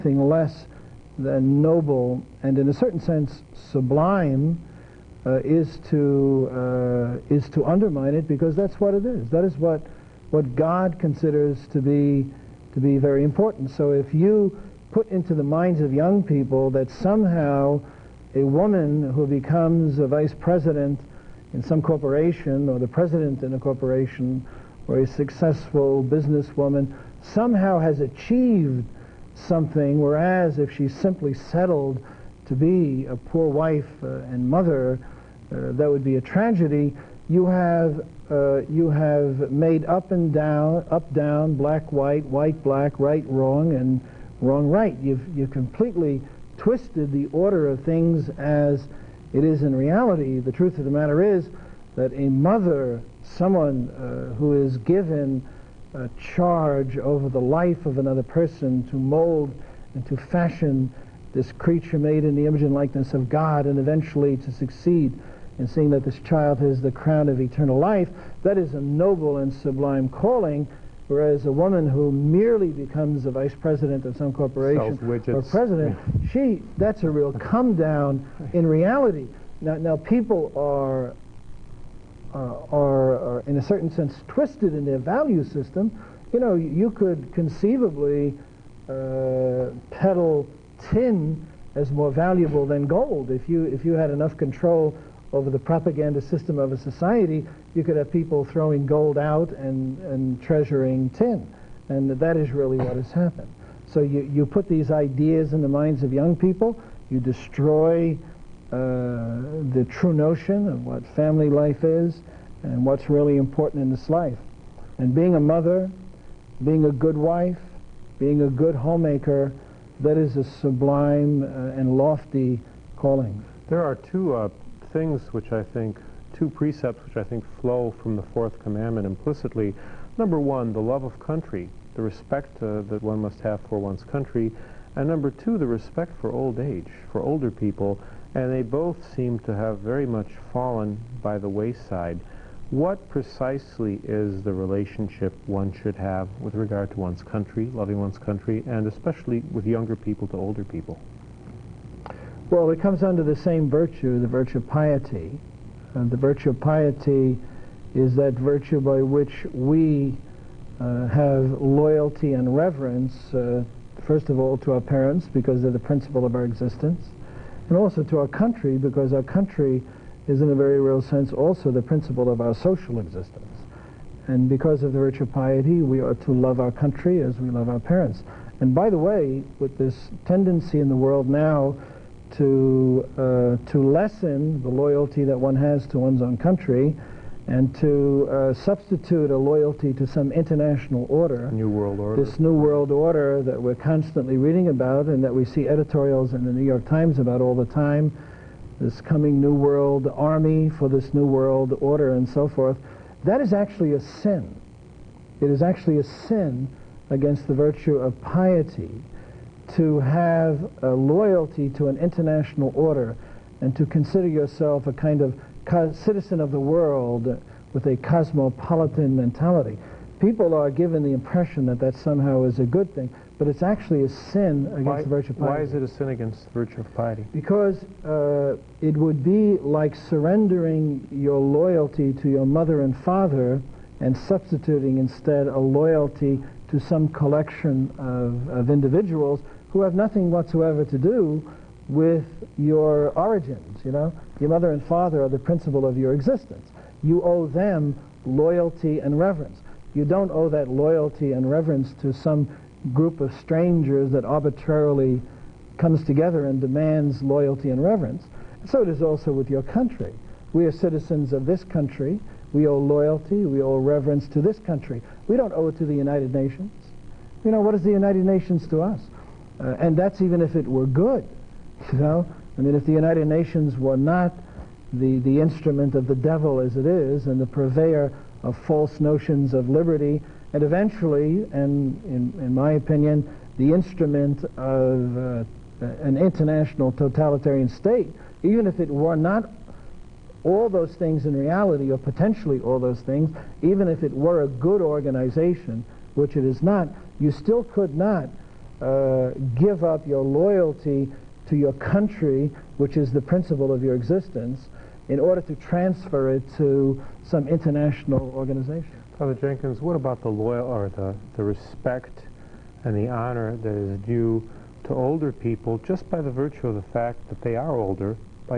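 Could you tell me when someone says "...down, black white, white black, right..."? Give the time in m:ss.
0:41.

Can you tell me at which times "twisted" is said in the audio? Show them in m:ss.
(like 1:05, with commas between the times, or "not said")
0:46, 1:24.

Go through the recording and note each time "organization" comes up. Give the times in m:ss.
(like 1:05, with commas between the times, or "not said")
4:54, 5:08.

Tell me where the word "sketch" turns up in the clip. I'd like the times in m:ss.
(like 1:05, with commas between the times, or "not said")
not said.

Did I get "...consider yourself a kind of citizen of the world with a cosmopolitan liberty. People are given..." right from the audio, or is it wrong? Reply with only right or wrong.
wrong.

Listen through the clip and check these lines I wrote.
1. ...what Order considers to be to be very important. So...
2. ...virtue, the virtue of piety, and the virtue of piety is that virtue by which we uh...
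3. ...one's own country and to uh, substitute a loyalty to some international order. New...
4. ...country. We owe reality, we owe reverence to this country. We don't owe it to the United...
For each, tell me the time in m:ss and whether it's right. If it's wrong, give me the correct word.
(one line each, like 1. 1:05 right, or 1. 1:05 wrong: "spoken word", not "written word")
1. 0:10 wrong: "God", not "Order"
2. 2:33 right
3. 3:05 right
4. 4:21 wrong: "loyalty", not "reality".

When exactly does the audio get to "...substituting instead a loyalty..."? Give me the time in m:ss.
3:54.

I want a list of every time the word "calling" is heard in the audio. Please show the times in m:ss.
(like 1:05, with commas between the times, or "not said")
1:10, 2:02.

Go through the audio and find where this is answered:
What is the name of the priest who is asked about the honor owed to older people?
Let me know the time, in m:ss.
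5:09.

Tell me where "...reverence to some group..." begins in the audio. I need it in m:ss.
4:11.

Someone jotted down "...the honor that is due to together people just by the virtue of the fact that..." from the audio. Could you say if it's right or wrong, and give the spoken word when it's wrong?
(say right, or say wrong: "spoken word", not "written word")
wrong: "older", not "together".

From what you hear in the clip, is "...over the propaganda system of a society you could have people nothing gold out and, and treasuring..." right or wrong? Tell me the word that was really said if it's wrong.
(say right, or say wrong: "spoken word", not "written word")
wrong: "throwing", not "nothing".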